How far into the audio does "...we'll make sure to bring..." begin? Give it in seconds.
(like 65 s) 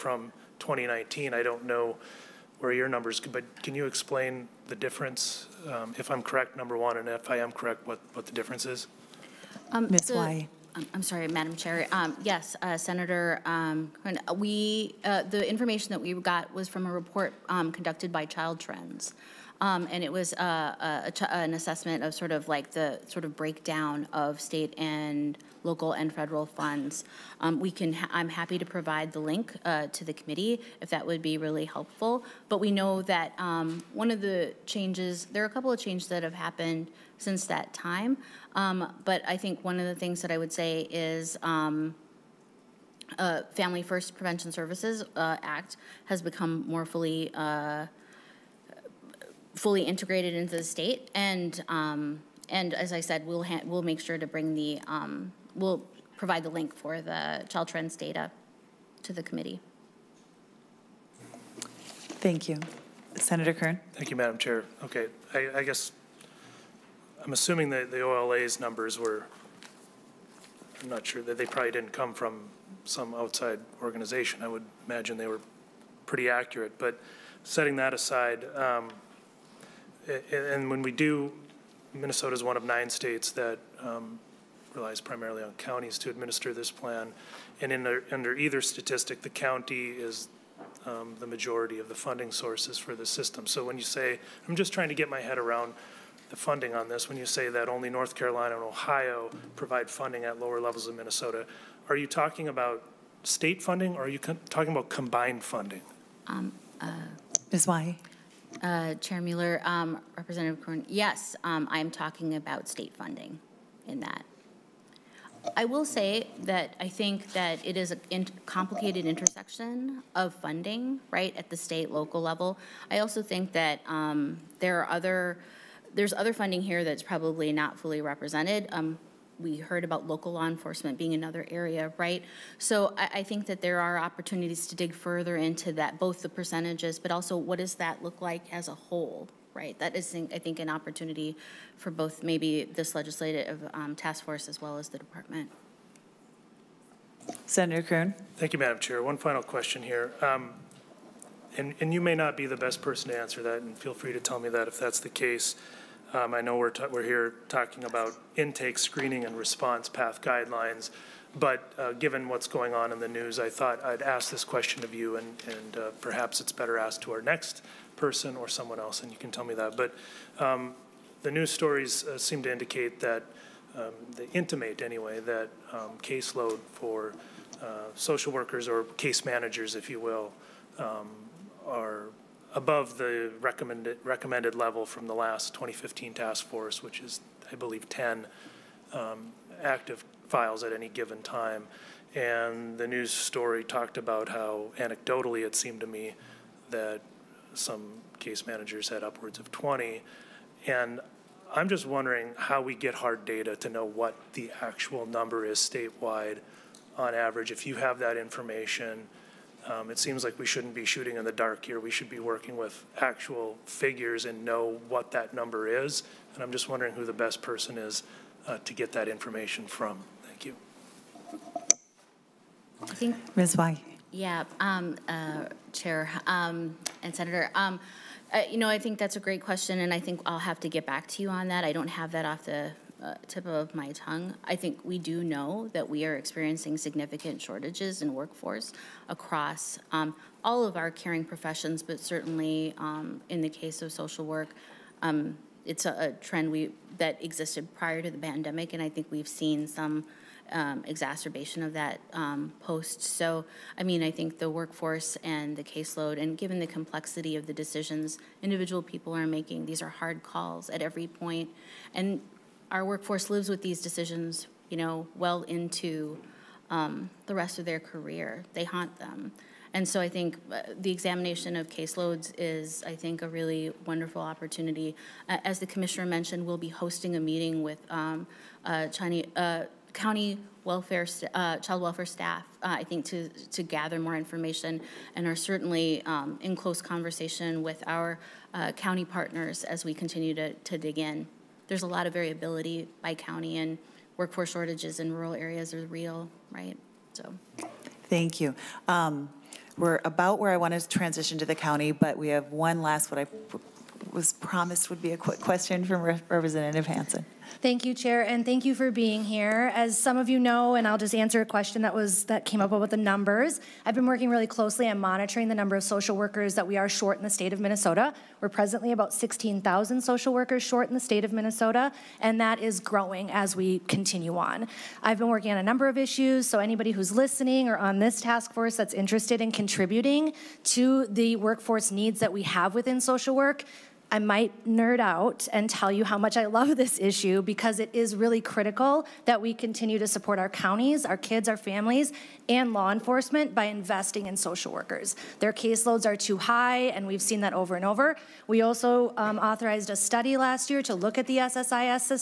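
53 s.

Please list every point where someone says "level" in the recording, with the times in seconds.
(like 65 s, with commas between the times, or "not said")
100 s, 122 s, 184 s.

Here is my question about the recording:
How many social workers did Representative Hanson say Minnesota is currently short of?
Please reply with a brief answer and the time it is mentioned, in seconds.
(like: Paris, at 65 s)
16,000, at 319 s.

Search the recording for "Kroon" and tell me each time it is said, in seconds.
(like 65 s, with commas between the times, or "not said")
147 s.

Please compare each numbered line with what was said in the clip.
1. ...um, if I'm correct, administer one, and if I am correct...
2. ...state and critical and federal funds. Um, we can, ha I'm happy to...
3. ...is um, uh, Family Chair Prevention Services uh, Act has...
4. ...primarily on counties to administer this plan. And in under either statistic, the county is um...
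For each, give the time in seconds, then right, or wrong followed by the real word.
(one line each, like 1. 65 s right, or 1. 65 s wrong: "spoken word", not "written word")
1. 5 s wrong: "number", not "administer"
2. 24 s wrong: "local", not "critical"
3. 40 s wrong: "First", not "Chair"
4. 85 s right.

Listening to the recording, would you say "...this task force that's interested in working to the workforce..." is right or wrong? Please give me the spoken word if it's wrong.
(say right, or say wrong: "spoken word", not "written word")
wrong: "contributing", not "working".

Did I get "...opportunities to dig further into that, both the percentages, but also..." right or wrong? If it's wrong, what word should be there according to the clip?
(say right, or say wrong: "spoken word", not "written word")
right.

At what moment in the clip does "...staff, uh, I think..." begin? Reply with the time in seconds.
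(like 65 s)
282 s.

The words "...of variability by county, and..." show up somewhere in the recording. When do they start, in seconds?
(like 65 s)
292 s.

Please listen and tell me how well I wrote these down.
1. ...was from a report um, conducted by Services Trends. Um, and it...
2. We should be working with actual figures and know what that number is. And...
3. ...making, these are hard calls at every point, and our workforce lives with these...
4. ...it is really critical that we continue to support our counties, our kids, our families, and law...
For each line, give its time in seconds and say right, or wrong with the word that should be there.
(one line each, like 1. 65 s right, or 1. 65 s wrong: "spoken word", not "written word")
1. 16 s wrong: "Child", not "Services"
2. 211 s right
3. 259 s right
4. 337 s right.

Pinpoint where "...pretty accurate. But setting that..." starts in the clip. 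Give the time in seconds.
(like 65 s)
76 s.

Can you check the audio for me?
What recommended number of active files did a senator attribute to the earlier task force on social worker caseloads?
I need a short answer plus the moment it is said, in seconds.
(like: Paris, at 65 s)
10, at 187 s.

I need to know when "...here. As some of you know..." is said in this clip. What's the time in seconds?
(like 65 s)
309 s.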